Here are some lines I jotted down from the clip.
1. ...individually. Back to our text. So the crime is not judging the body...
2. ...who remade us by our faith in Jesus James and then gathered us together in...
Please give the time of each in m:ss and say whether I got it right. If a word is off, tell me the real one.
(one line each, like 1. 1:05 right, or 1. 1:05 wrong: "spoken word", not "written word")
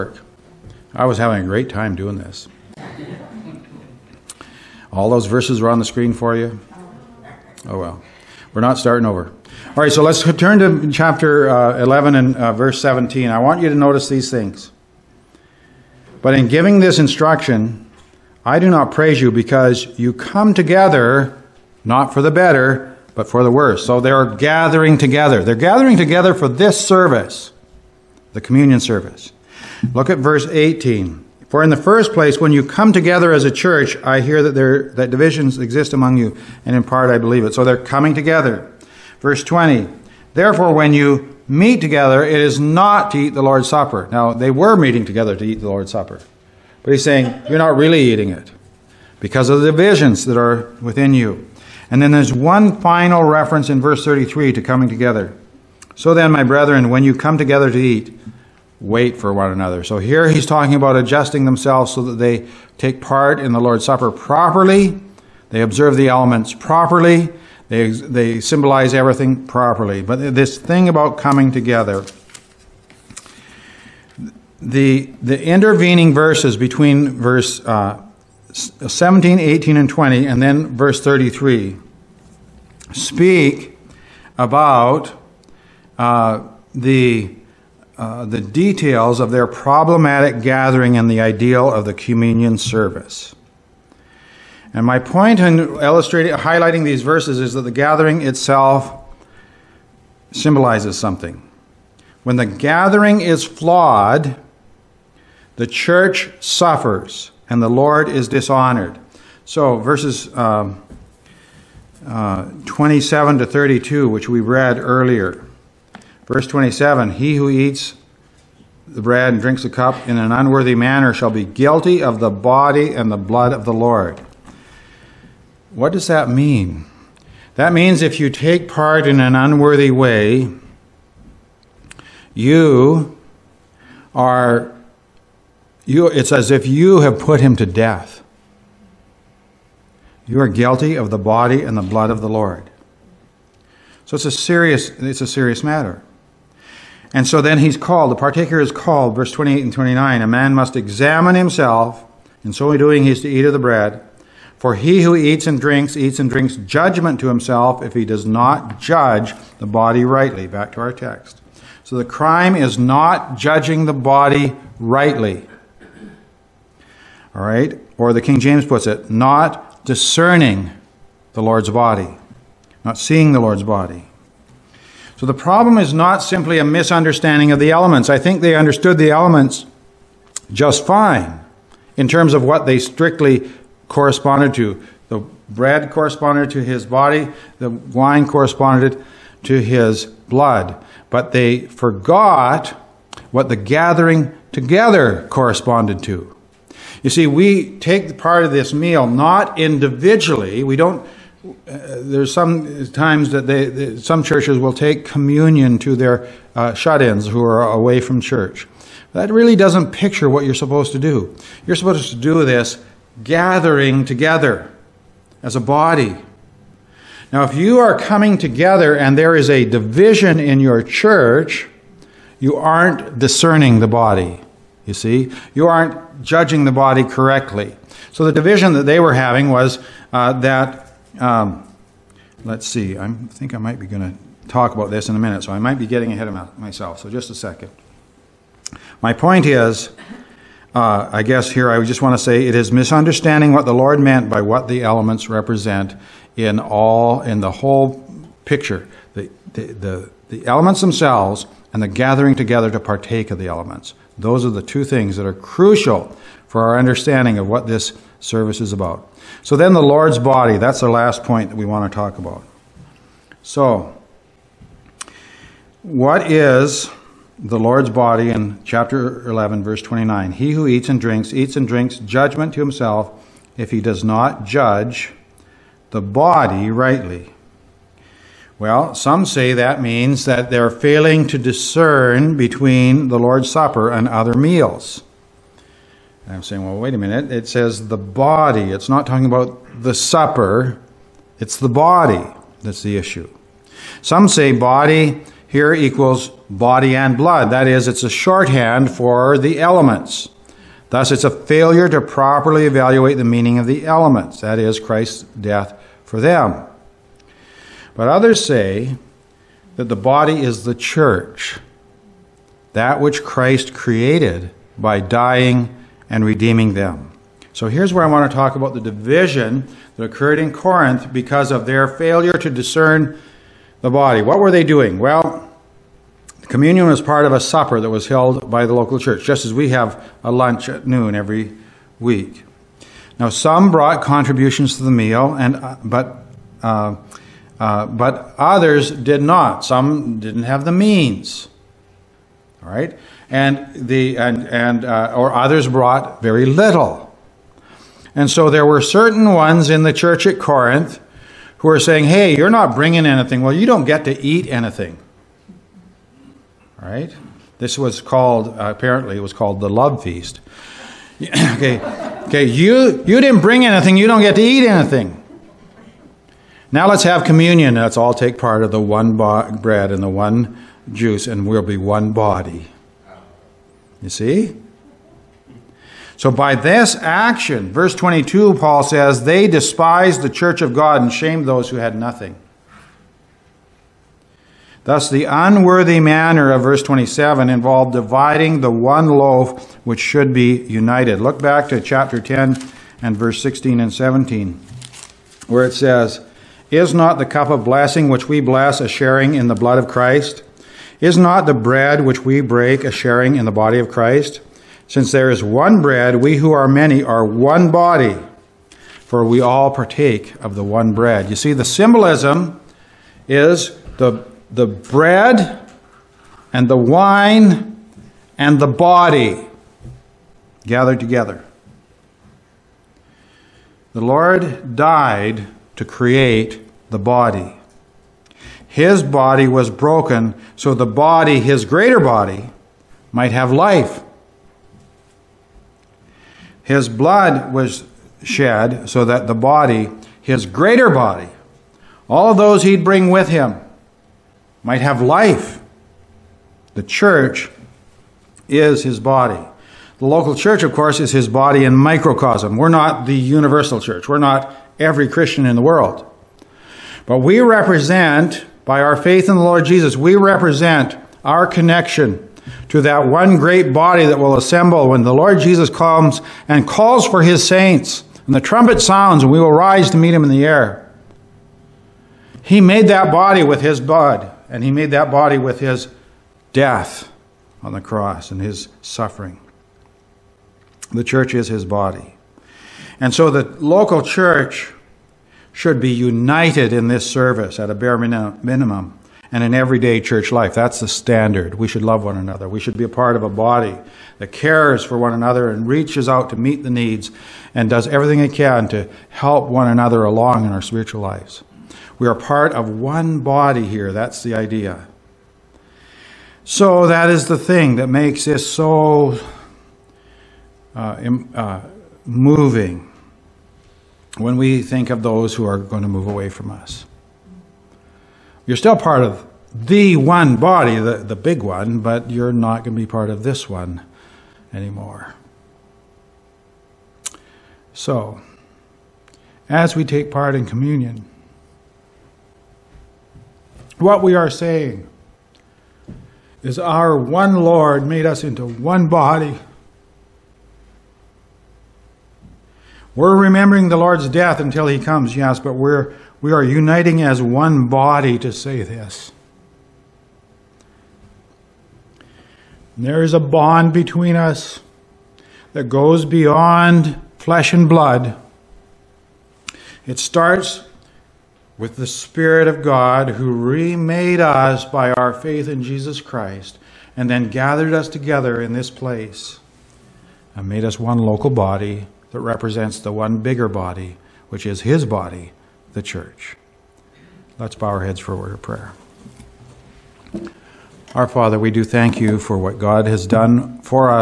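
1. 2:40 wrong: "rightly", not "individually"
2. 9:23 wrong: "Christ", not "James".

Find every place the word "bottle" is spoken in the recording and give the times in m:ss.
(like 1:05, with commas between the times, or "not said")
not said.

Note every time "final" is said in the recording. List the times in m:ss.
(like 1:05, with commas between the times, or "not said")
0:52.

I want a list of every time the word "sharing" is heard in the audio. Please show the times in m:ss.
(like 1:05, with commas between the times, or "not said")
6:38, 6:42.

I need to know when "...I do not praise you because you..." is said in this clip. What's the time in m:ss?
0:18.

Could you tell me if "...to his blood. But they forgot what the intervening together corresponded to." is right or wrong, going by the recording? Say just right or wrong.
wrong.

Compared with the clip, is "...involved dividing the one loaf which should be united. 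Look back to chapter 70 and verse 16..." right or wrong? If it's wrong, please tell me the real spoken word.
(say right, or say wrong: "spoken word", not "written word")
wrong: "10", not "70".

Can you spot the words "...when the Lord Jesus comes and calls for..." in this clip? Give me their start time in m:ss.
7:44.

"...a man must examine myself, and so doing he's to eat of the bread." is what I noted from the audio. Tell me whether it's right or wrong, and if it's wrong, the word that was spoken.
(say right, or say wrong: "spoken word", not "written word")
wrong: "himself", not "myself".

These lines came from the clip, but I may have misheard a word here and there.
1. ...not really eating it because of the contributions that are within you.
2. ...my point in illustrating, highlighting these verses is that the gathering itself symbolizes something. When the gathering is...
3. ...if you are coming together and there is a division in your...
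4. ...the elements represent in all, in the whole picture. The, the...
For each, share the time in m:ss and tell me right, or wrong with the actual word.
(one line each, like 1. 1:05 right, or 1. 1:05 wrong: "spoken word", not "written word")
1. 0:47 wrong: "divisions", not "contributions"
2. 1:34 right
3. 3:37 right
4. 4:04 right.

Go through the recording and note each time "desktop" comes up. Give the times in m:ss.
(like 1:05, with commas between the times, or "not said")
not said.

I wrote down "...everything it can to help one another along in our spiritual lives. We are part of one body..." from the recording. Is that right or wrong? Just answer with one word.
right.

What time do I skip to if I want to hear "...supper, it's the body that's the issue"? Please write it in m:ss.
4:49.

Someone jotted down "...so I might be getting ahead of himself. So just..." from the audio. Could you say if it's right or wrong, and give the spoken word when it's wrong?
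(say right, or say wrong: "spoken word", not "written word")
wrong: "myself", not "himself".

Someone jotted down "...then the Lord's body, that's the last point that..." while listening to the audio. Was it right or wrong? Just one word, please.
right.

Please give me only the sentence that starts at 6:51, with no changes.
You see, the symbolism is the, the bread and the wine and the body gathered together.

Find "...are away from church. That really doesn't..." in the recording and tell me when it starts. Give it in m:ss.
3:27.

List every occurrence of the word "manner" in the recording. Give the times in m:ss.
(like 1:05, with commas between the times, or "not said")
2:00, 6:25.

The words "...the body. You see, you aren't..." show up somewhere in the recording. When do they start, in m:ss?
3:43.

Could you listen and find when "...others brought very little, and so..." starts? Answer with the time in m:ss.
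5:45.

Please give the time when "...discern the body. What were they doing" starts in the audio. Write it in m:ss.
5:22.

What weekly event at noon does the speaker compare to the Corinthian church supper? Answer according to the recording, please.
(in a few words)
a lunch.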